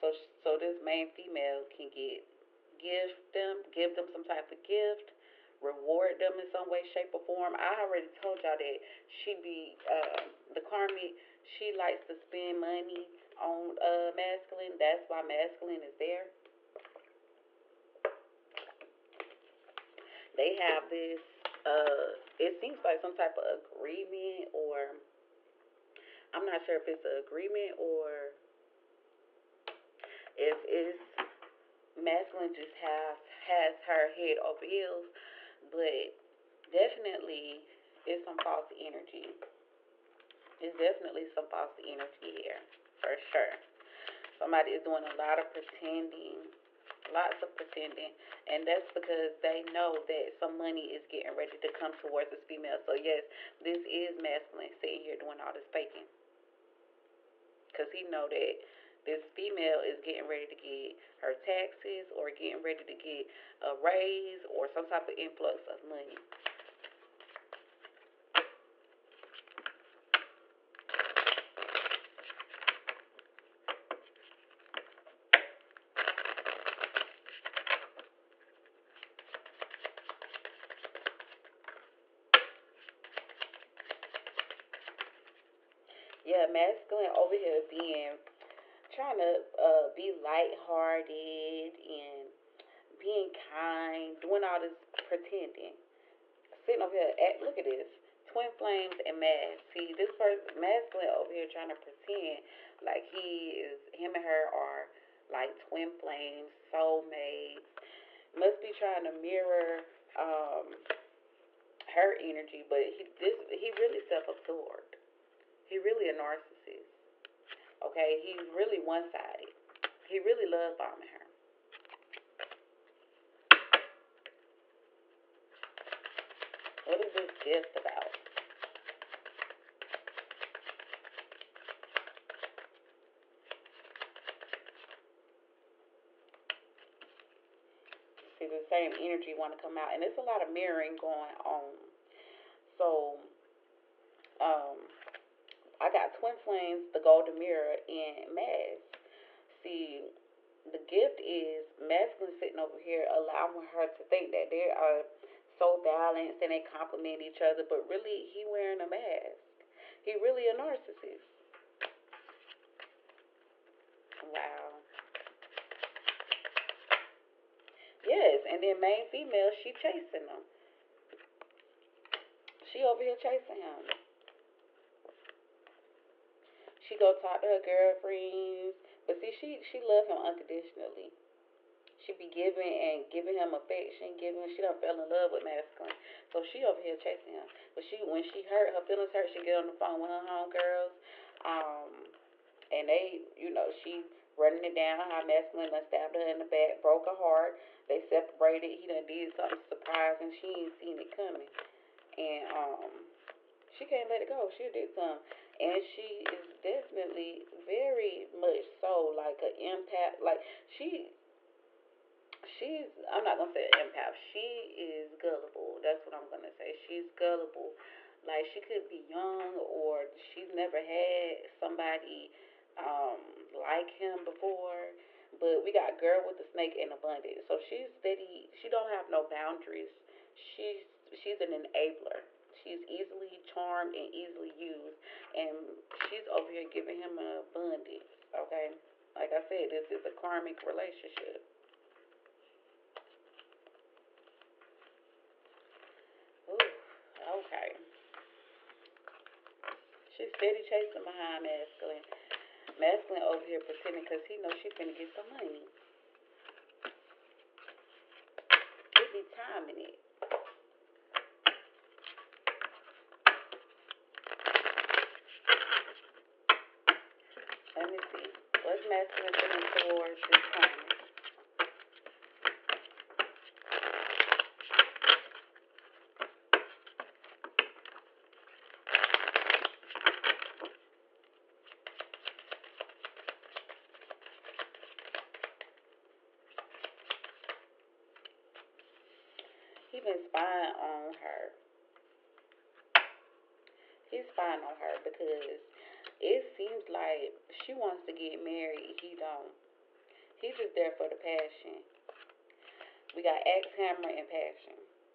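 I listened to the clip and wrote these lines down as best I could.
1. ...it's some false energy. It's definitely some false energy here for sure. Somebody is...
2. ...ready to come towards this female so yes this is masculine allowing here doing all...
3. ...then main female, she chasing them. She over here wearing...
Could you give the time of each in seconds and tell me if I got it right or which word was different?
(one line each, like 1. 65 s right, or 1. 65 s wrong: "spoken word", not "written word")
1. 38 s right
2. 51 s wrong: "sitting", not "allowing"
3. 168 s wrong: "chasing", not "wearing".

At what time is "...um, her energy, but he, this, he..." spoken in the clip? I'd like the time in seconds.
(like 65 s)
110 s.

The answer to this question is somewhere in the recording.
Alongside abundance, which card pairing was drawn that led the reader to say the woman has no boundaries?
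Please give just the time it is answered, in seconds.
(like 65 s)
225 s.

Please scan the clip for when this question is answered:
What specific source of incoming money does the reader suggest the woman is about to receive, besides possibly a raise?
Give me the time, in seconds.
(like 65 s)
61 s.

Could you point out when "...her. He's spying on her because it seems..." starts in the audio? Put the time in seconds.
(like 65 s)
291 s.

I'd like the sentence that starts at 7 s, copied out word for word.
I already told y'all that she be uh, the karmic.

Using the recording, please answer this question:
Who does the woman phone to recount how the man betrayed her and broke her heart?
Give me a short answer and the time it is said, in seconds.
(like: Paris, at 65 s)
Her homegirls, at 190 s.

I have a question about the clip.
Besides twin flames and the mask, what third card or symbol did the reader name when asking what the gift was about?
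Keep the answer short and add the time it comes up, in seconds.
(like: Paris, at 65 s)
The golden mirror, at 146 s.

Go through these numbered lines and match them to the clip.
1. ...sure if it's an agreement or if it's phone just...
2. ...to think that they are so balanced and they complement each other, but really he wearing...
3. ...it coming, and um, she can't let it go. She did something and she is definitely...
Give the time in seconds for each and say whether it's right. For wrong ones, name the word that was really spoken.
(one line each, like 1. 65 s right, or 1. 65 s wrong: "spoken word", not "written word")
1. 26 s wrong: "masculine", not "phone"
2. 153 s right
3. 201 s right.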